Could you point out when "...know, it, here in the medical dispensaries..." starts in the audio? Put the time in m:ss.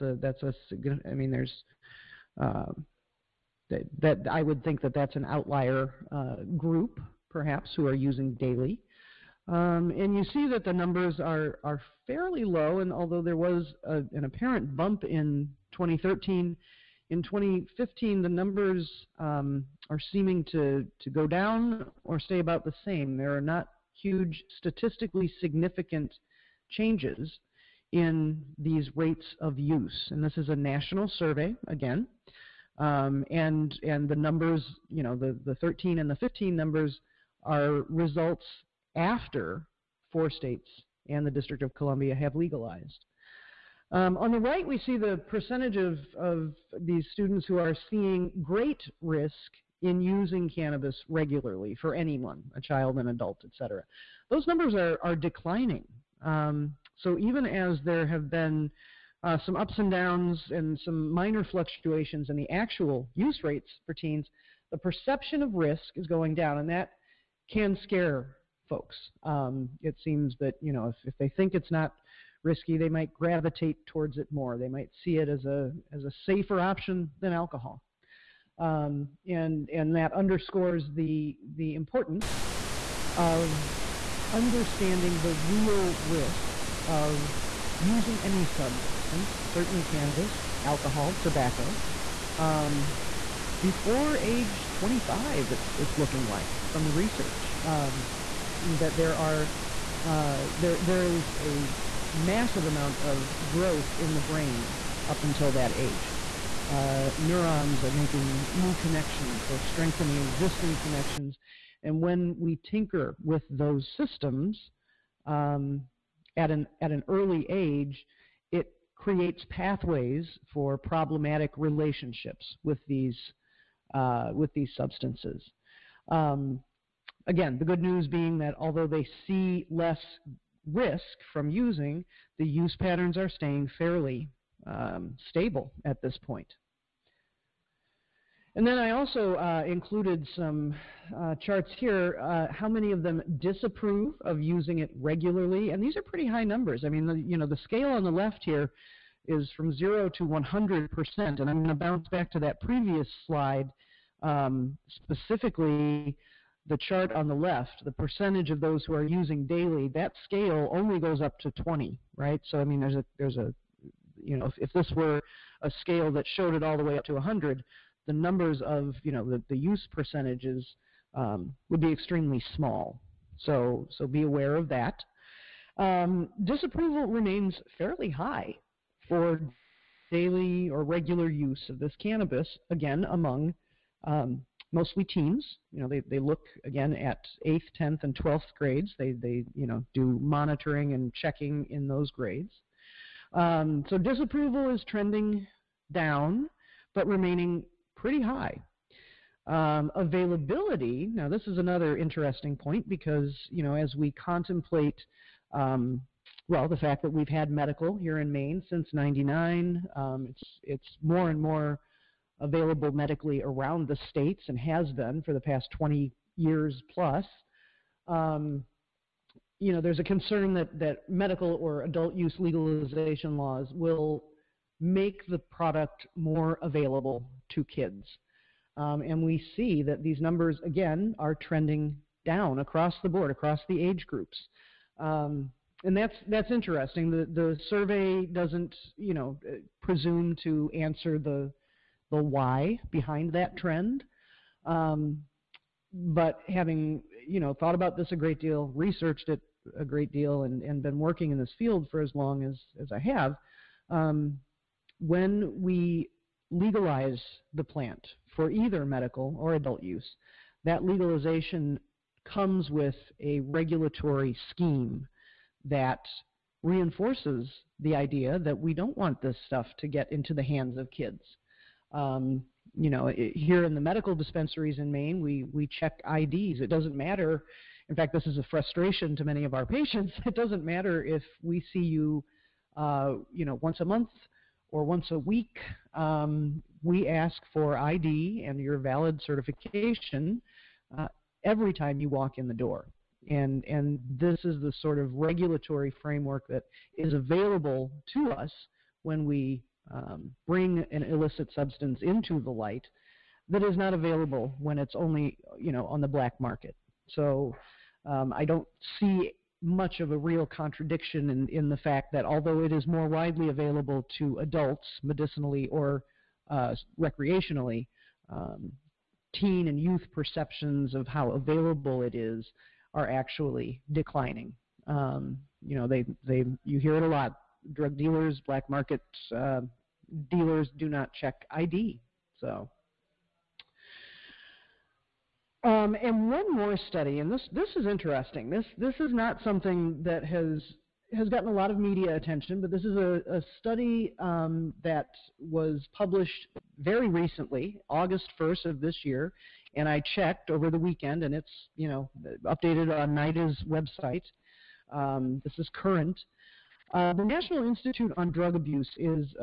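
4:32.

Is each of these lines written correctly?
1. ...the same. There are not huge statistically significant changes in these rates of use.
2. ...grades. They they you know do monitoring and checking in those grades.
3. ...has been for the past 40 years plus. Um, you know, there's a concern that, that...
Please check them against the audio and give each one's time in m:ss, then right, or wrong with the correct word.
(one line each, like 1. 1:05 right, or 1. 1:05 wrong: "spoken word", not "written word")
1. 0:22 right
2. 3:08 right
3. 3:34 wrong: "20", not "40".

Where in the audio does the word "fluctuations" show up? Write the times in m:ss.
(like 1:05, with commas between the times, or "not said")
1:01.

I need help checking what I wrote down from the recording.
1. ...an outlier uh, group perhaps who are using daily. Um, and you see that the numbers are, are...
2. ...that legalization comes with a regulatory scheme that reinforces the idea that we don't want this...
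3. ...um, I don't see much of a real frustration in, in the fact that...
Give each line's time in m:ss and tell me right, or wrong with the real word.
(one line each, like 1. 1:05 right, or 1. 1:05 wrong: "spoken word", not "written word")
1. 0:05 right
2. 4:20 right
3. 5:08 wrong: "contradiction", not "frustration".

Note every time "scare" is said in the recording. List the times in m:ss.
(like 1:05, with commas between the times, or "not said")
1:07.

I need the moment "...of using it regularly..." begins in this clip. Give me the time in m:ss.
2:24.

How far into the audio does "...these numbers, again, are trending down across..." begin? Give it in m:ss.
3:50.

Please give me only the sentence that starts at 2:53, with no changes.
So so be aware of that.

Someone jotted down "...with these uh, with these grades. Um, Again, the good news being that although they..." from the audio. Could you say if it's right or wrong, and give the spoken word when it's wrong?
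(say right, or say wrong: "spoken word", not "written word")
wrong: "substances", not "grades".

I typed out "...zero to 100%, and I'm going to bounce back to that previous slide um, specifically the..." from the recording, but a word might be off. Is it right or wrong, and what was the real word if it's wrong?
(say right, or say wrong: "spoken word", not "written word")
right.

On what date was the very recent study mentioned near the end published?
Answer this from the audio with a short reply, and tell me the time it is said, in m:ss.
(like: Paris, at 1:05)
August 1st, at 5:47.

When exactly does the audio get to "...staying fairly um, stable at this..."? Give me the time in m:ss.
2:13.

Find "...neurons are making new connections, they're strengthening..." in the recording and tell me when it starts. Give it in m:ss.
1:47.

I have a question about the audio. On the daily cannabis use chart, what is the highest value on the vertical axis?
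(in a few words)
20.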